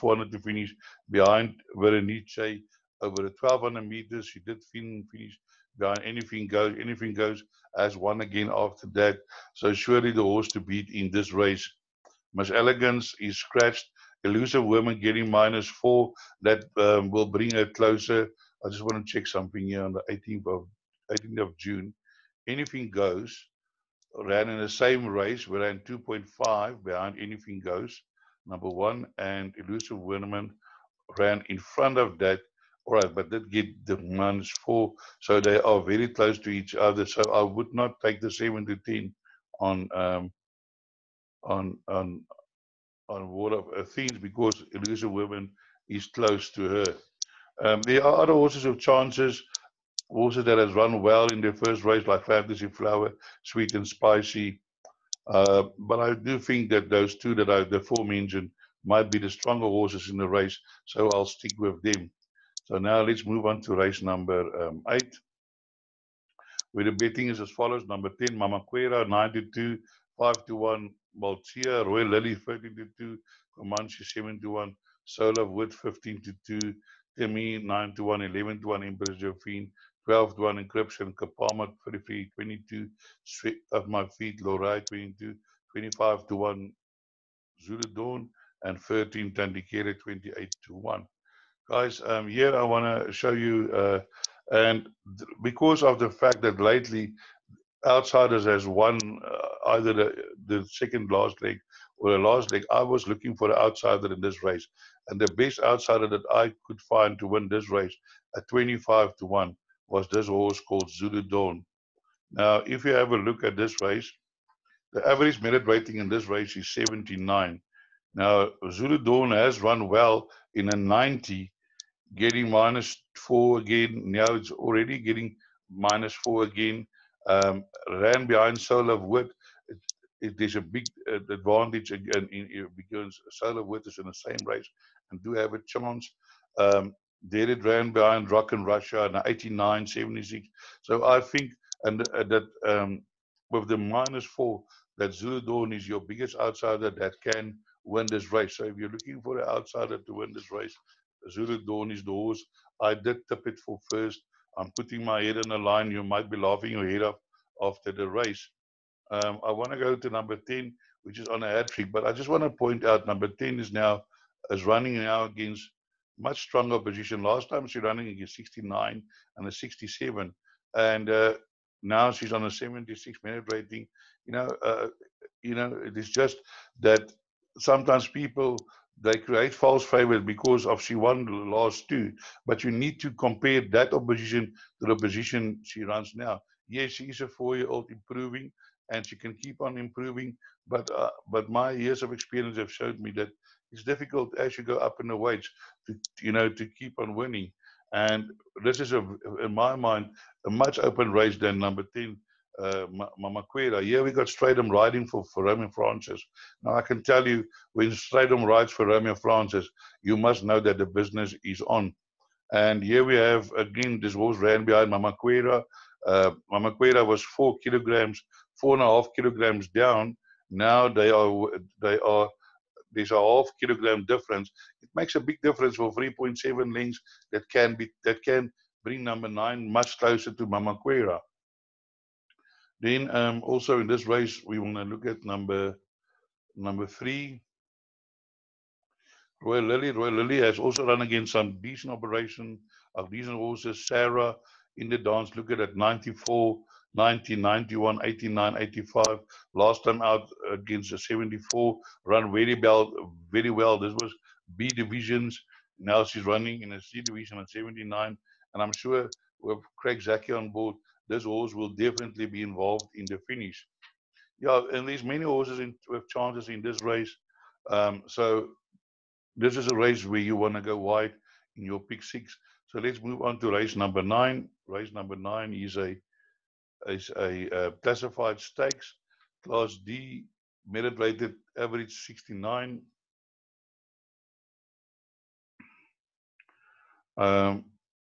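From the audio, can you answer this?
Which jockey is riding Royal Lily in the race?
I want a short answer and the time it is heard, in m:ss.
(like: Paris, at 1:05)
Craig Zackey, at 4:19.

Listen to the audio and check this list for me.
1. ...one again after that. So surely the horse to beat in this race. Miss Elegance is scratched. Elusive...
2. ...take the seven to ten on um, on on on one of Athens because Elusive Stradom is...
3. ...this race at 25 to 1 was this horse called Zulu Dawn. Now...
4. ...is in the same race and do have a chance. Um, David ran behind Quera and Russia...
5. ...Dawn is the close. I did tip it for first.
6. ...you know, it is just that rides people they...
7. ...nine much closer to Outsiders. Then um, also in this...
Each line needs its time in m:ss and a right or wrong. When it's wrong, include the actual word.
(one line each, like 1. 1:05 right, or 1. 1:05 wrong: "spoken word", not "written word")
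1. 0:07 right
2. 0:38 wrong: "Women", not "Stradom"
3. 1:47 right
4. 2:13 wrong: "Rock", not "Quera"
5. 2:31 wrong: "horse", not "close"
6. 2:55 wrong: "sometimes", not "rides"
7. 3:49 wrong: "Mamaquera", not "Outsiders".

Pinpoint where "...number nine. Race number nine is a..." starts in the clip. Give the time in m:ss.
4:33.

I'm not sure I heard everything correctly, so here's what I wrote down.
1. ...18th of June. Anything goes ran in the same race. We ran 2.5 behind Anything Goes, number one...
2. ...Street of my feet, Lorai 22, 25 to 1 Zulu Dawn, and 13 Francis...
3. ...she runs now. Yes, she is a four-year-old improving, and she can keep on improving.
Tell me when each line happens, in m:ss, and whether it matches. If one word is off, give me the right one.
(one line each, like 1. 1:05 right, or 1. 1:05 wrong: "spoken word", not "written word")
1. 0:21 right
2. 1:23 wrong: "Tandikere", not "Francis"
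3. 3:05 right.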